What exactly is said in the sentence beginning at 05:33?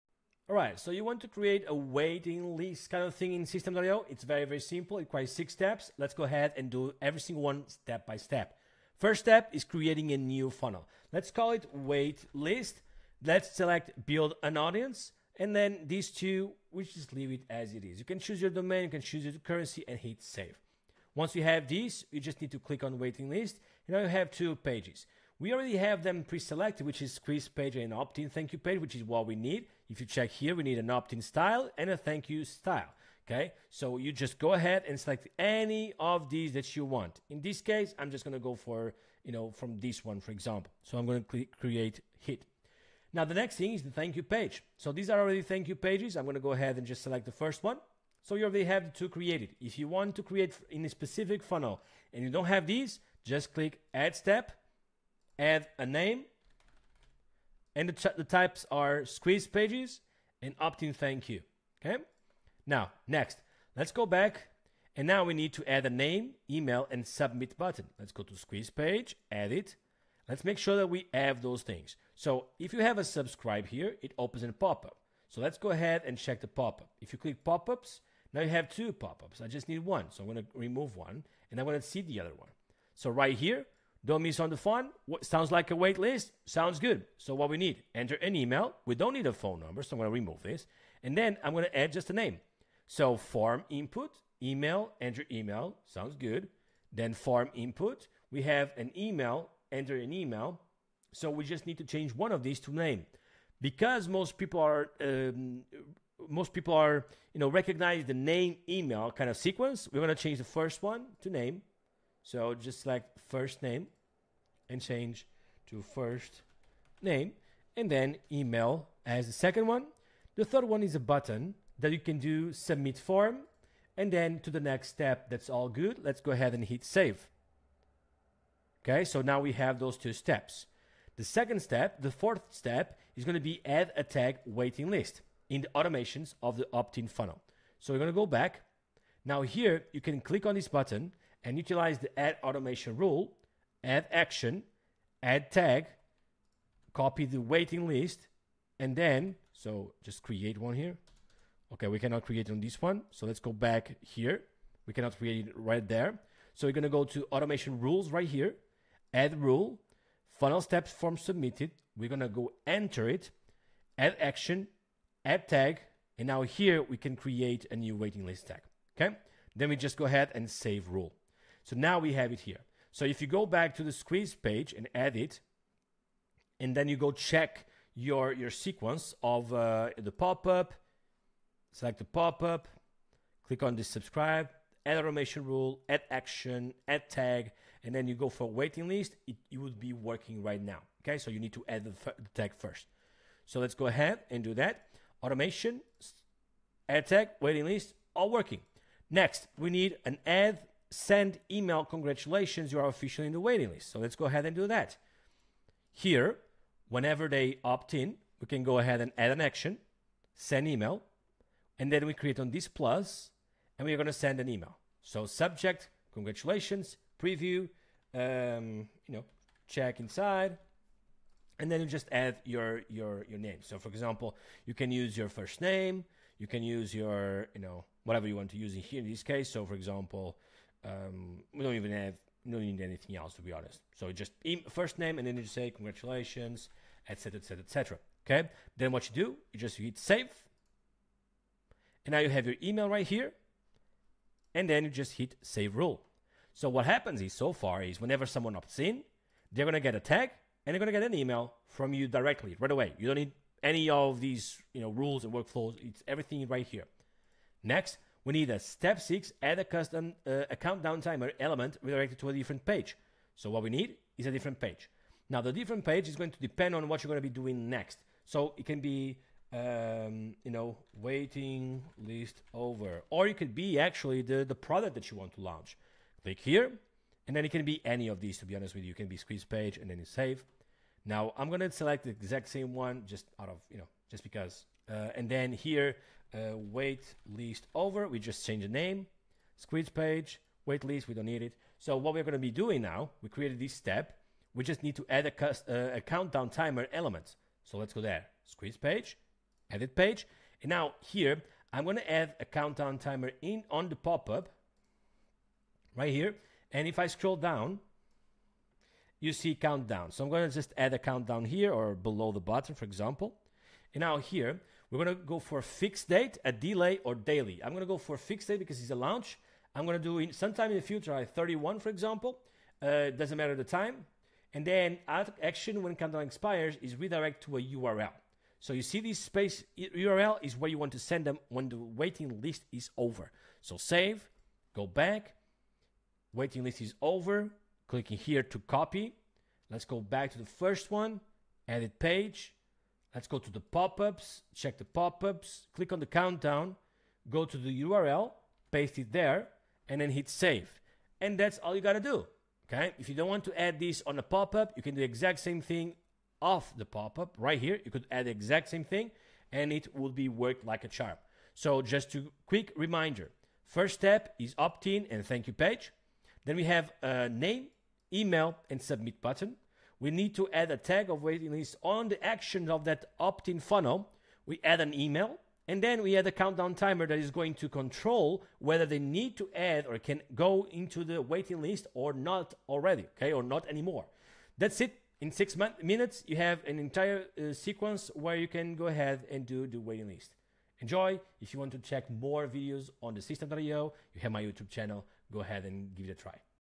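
So save, go back, waiting list is over, clicking here to copy.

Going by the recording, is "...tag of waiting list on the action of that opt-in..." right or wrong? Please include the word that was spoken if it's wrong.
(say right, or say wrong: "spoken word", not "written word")
right.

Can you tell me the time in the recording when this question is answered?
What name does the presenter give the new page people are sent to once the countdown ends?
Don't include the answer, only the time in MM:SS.
04:46.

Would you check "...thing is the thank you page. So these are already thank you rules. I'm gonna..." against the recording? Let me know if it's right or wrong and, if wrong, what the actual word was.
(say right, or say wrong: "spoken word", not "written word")
wrong: "pages", not "rules".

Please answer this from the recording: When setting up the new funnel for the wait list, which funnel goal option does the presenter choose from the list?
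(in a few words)
Build an audience.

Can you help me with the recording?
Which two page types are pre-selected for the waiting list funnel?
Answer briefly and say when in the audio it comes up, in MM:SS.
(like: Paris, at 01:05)
Squeeze page and opt-in thank you page, at 00:27.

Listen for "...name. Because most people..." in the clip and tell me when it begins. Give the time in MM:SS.
01:42.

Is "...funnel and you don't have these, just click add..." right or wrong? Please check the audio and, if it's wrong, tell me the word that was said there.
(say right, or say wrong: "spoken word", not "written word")
right.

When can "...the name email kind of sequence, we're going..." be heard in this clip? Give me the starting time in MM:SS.
01:48.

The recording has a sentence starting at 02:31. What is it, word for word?
Okay, we cannot create on this one.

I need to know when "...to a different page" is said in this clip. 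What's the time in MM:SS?
04:22.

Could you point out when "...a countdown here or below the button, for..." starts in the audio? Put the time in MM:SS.
05:10.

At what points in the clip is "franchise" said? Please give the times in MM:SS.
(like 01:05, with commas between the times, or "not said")
not said.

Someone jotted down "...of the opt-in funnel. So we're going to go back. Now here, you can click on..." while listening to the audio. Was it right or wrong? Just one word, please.
right.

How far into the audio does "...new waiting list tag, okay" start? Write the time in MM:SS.
02:47.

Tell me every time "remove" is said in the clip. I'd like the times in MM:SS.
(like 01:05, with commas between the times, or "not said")
01:20, 01:30.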